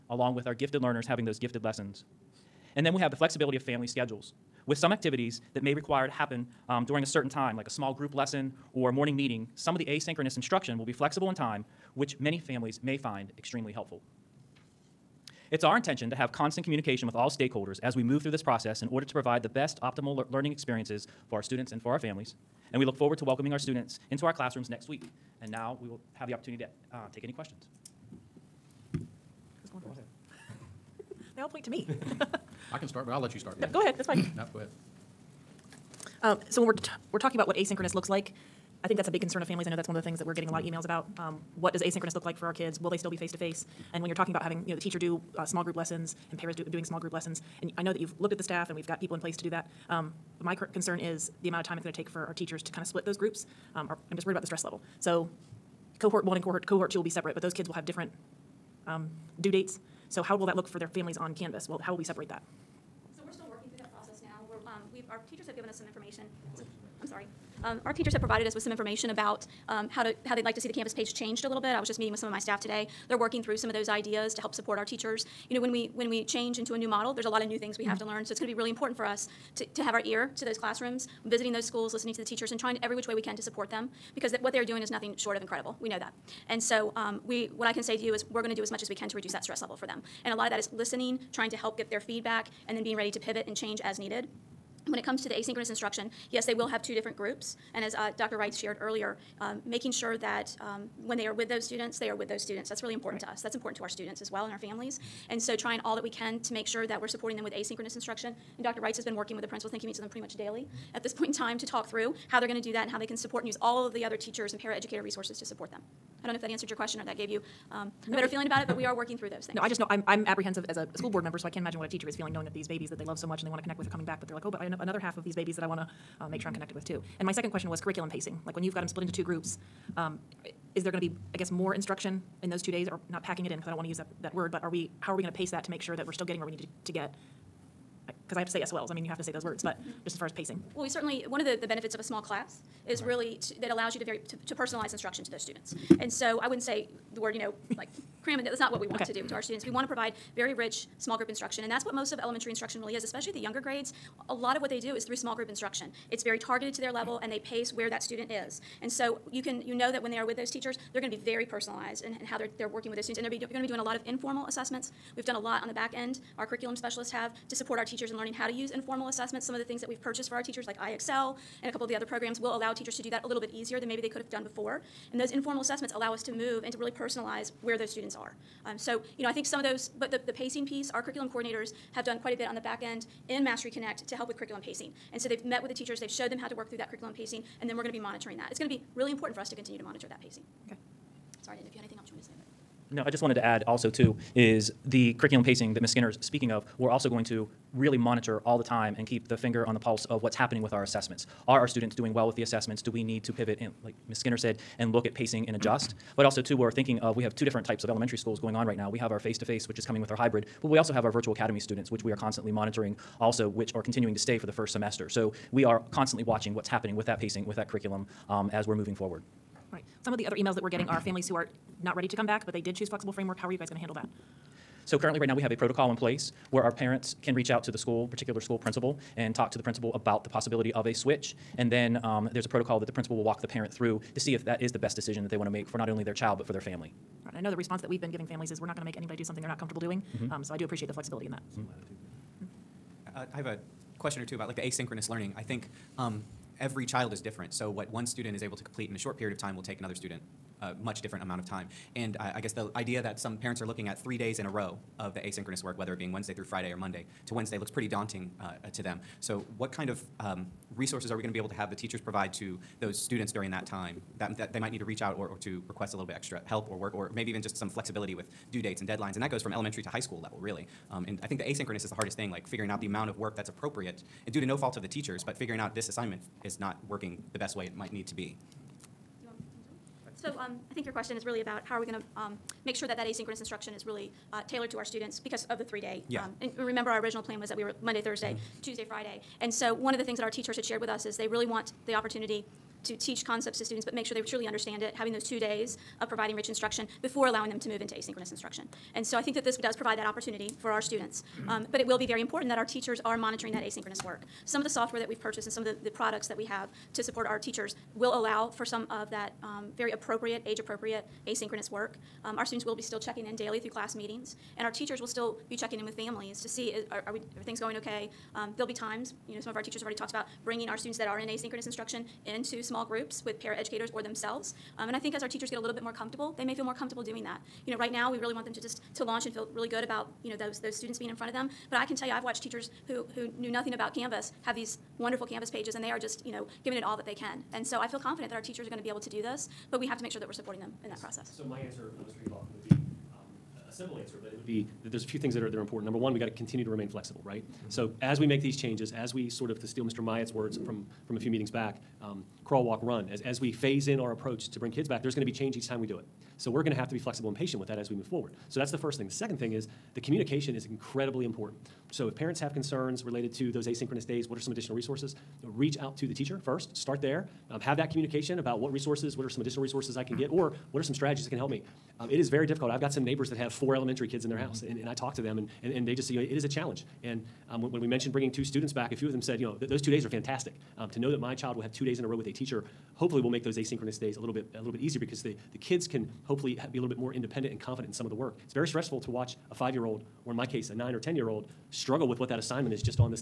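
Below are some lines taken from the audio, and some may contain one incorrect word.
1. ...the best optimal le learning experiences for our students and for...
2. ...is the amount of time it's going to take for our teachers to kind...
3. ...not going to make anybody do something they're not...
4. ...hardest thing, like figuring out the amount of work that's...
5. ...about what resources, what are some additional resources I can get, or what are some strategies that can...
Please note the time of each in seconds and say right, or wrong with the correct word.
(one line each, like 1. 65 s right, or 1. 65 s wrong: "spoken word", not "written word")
1. 19 s right
2. 50 s right
3. 238 s right
4. 271 s right
5. 368 s right.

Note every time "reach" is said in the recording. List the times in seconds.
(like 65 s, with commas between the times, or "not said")
227 s, 264 s, 365 s.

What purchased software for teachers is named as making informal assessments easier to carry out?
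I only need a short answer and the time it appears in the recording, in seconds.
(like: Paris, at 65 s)
IXL, at 170 s.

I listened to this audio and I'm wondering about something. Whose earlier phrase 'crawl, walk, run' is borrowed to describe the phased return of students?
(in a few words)
Mr. Myatt.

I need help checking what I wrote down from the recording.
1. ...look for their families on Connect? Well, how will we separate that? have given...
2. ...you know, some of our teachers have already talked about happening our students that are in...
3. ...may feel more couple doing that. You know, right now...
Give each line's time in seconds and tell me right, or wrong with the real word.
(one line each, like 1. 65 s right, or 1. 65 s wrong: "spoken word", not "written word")
1. 60 s wrong: "Canvas", not "Connect"
2. 319 s wrong: "bringing", not "happening"
3. 326 s wrong: "comfortable", not "couple".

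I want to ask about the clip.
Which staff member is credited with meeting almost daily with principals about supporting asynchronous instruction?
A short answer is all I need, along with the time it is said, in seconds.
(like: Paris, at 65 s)
Dr. Wright, at 108 s.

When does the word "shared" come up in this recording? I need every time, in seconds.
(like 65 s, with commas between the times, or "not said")
98 s, 290 s.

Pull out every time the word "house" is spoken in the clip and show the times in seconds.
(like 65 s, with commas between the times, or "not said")
374 s.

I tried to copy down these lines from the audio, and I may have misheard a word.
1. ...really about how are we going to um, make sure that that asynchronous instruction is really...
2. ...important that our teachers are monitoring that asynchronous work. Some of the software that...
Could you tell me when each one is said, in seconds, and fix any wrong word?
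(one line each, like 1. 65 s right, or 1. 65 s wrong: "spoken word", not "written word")
1. 281 s right
2. 302 s right.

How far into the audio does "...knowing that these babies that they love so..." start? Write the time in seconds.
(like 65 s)
122 s.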